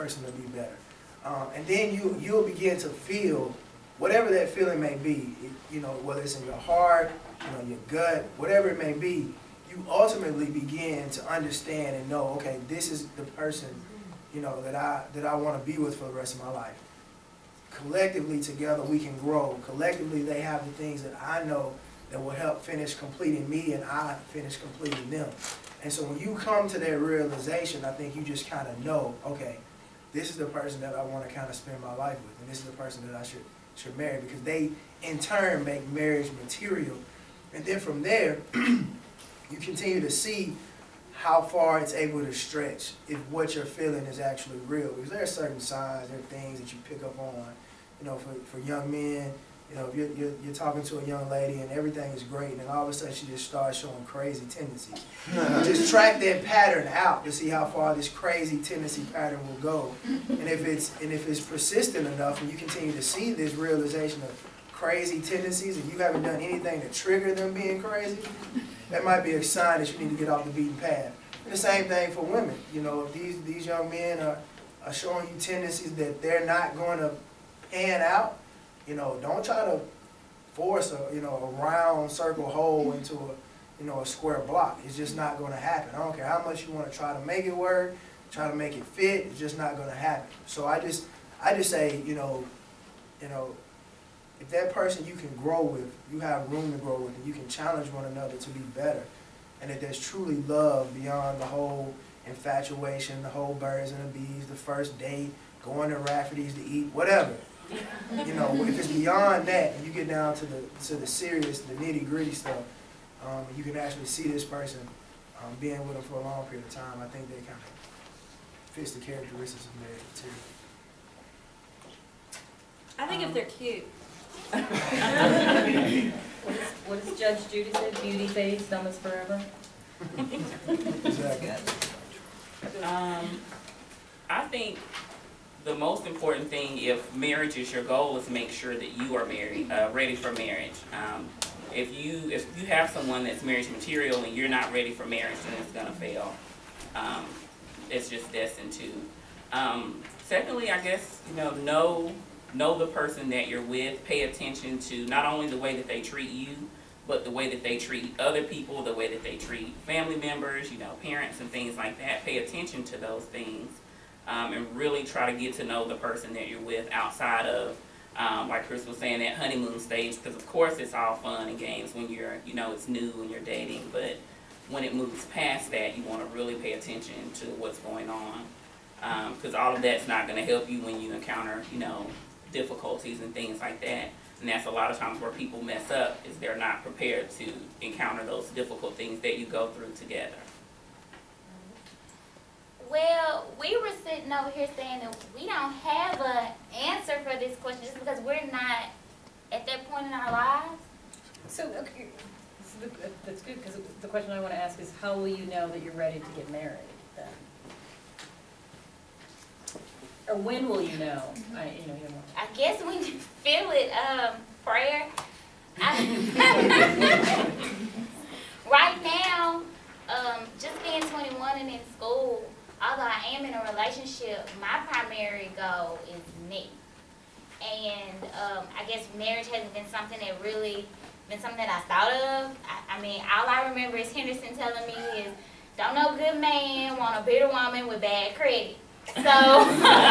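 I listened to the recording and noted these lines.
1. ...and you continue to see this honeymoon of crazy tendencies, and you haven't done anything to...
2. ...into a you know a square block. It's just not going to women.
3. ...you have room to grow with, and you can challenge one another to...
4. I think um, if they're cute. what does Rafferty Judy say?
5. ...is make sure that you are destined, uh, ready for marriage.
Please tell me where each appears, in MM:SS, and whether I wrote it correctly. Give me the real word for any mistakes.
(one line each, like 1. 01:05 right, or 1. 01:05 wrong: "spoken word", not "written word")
1. 01:02 wrong: "realization", not "honeymoon"
2. 01:22 wrong: "happen", not "women"
3. 01:36 right
4. 02:02 wrong: "Judge", not "Rafferty"
5. 02:18 wrong: "married", not "destined".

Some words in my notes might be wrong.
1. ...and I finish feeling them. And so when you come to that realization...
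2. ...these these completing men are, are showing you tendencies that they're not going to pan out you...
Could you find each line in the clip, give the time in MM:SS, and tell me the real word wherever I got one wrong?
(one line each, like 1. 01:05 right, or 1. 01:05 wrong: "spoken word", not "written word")
1. 00:23 wrong: "completing", not "feeling"
2. 01:13 wrong: "young", not "completing".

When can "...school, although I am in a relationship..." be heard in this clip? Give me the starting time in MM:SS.
03:41.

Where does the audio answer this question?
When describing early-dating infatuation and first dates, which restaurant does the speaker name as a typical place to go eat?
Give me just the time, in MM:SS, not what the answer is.
01:45.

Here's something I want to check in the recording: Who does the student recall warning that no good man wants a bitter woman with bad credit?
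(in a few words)
Henderson.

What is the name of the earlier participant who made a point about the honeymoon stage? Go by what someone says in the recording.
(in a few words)
Chris.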